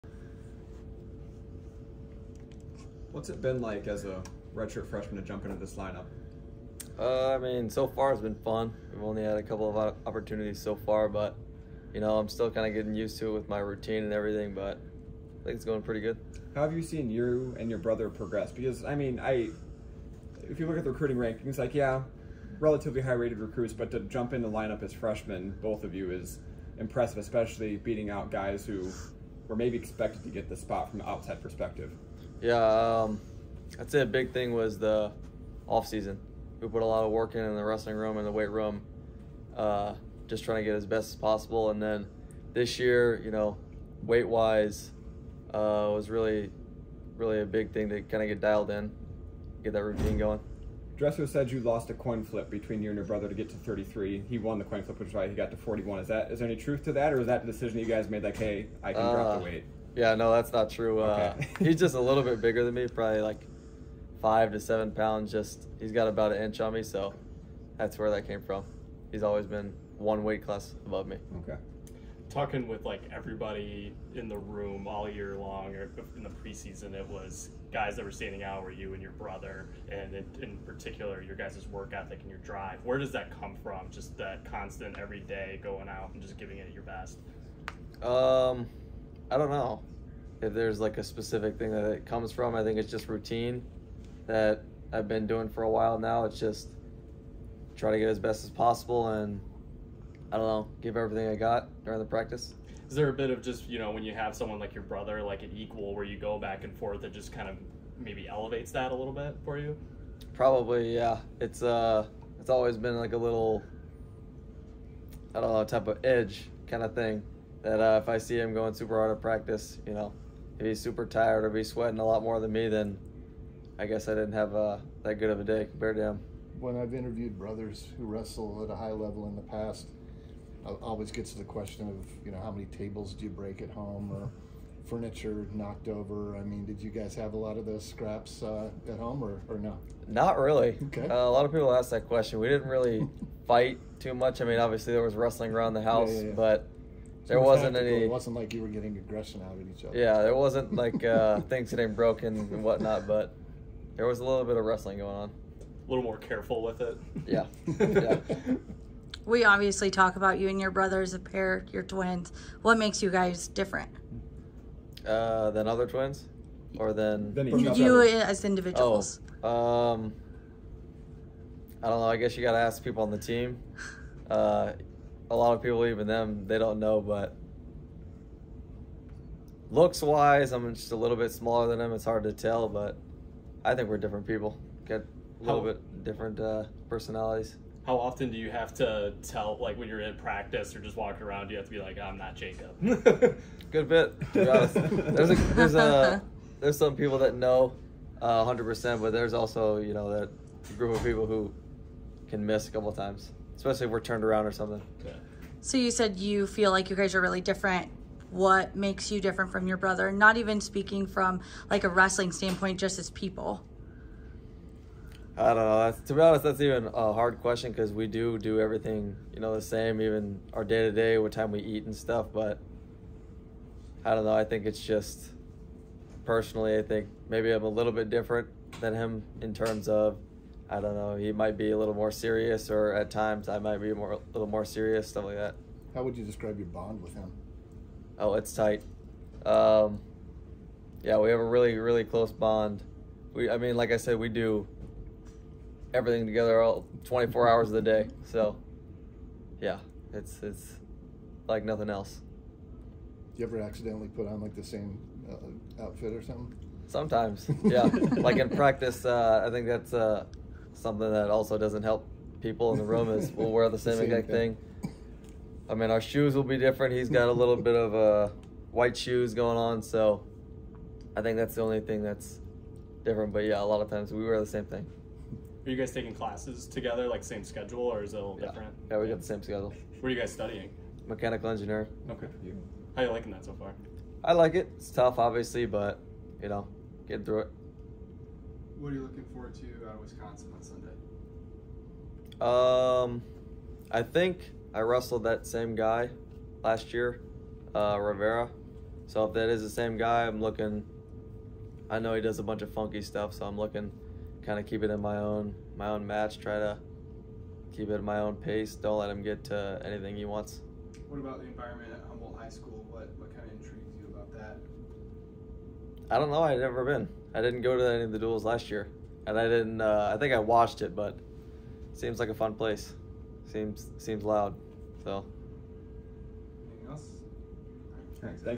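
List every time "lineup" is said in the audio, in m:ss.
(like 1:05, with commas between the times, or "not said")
0:05, 0:24.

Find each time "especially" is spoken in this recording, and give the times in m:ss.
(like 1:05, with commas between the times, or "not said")
0:27, 3:23.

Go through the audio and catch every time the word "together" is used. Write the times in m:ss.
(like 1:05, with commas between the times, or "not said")
4:06, 4:36.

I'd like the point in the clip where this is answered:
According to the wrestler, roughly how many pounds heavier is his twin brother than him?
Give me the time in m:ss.
1:04.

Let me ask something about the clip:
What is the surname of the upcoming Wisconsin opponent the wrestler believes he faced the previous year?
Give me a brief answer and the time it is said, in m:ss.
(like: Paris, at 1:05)
Rivera, at 4:58.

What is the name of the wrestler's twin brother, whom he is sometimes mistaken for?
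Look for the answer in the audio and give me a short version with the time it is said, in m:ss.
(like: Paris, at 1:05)
Jacob, at 3:12.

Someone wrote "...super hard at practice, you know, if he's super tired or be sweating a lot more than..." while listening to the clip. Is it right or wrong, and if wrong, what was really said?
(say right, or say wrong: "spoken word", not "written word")
right.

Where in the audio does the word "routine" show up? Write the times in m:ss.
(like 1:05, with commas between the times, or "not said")
0:13, 0:49, 1:33.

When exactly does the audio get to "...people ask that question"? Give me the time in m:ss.
2:21.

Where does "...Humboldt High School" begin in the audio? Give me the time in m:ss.
5:12.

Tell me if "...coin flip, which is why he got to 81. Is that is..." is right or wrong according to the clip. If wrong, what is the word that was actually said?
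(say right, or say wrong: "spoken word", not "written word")
wrong: "41", not "81".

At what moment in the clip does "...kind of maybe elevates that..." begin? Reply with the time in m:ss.
1:47.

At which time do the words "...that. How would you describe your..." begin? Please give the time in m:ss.
3:55.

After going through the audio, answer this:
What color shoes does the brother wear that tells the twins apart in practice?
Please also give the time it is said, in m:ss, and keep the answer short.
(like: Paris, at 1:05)
White, at 4:28.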